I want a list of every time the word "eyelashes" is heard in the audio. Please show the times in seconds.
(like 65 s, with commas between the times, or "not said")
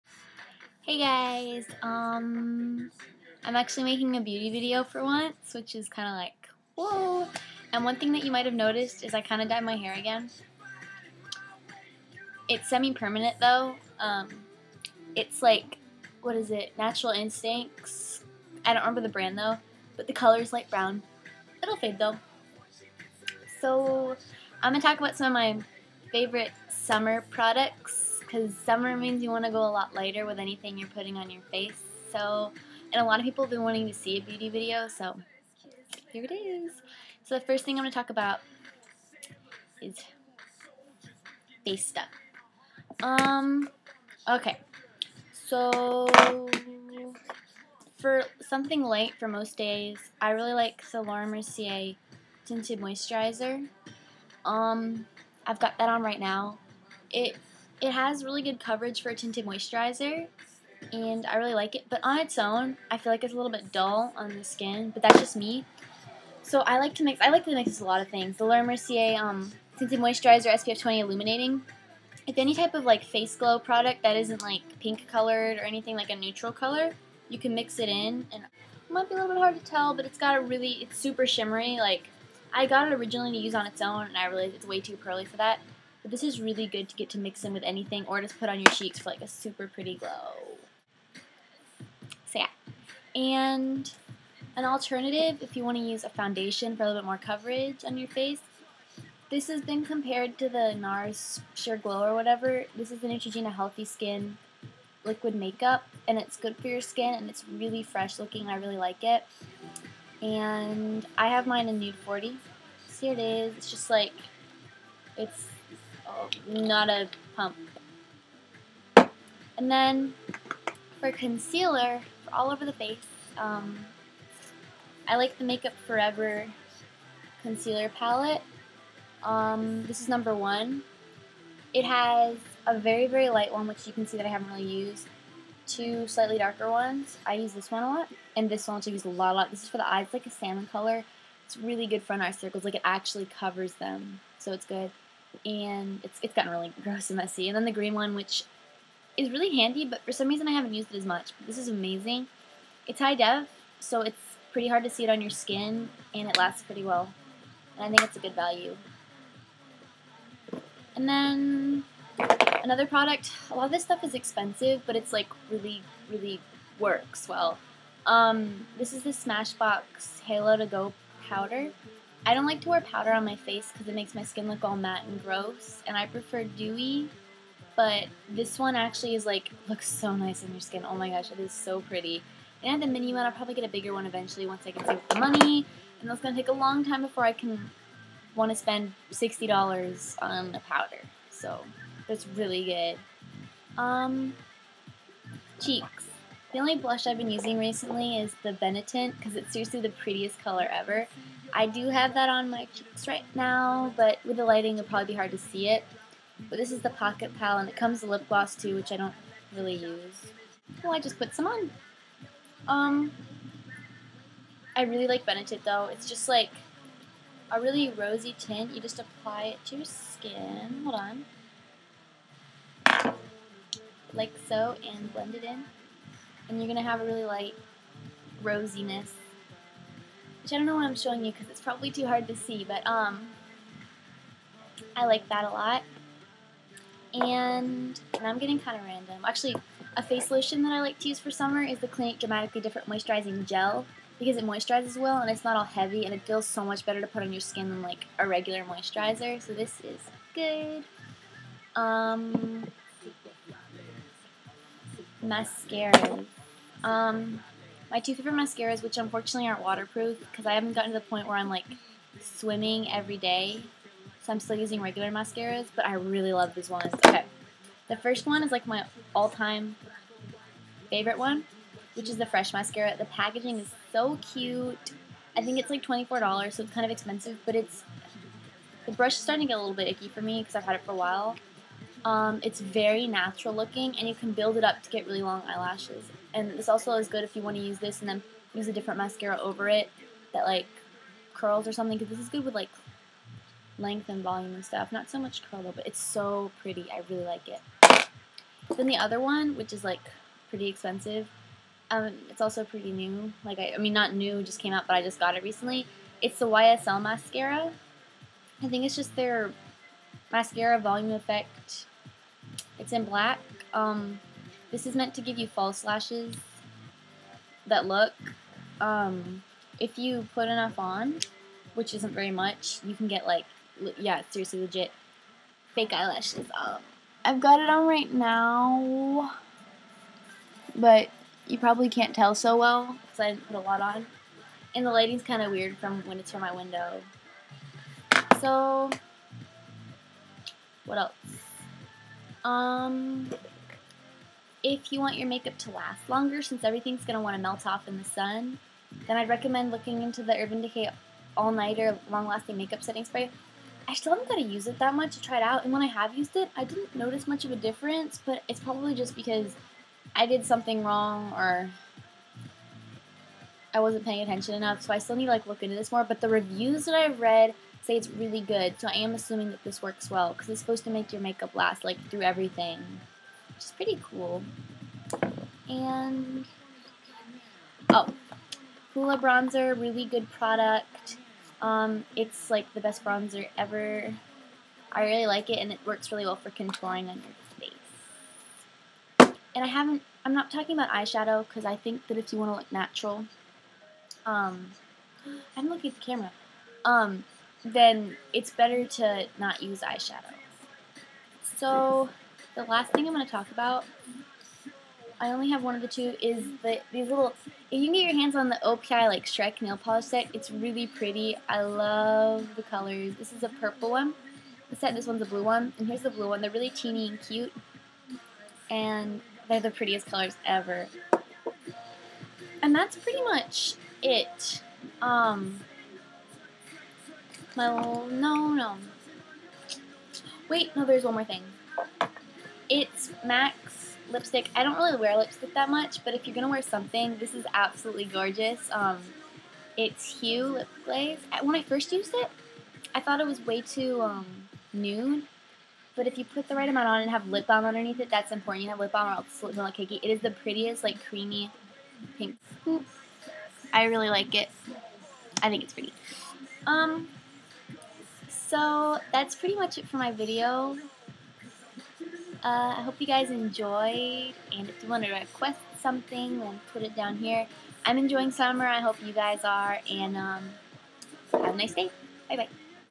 285 s, 325 s.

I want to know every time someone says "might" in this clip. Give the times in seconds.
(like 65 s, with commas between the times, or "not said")
8 s, 78 s.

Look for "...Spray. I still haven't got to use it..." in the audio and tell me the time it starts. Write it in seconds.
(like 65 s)
353 s.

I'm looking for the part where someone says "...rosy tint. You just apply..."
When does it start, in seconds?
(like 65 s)
217 s.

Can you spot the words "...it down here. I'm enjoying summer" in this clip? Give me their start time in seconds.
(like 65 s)
466 s.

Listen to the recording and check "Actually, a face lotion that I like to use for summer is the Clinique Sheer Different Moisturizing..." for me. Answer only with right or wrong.
wrong.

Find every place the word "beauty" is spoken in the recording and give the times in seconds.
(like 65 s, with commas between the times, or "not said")
4 s, 34 s.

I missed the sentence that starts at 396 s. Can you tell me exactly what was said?
Um, then it's better to not use eyeshadow.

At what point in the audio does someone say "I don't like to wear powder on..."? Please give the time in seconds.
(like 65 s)
172 s.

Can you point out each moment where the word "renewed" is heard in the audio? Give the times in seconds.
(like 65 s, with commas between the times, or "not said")
not said.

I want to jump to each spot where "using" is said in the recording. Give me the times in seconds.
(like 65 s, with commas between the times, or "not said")
197 s, 264 s.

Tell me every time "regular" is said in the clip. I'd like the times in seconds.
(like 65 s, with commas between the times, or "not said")
248 s, 264 s.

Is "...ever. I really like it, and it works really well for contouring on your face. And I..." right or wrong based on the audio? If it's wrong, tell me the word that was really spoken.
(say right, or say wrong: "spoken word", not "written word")
right.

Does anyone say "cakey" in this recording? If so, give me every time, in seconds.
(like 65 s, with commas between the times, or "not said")
449 s.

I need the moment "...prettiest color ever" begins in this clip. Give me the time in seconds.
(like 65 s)
199 s.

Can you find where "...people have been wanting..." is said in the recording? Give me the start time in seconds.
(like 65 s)
33 s.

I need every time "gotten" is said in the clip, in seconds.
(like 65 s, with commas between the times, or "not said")
146 s, 260 s.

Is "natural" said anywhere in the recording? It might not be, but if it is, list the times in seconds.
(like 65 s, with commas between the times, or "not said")
16 s, 283 s, 392 s.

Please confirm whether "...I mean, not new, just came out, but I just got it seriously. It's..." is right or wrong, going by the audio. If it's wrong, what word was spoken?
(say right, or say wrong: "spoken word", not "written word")
wrong: "recently", not "seriously".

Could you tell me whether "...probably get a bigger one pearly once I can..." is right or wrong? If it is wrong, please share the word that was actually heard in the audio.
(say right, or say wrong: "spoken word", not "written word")
wrong: "eventually", not "pearly".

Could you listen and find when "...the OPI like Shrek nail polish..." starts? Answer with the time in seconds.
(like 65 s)
408 s.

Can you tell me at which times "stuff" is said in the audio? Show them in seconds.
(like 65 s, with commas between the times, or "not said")
41 s, 163 s, 294 s.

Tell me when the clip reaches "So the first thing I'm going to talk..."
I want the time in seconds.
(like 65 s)
37 s.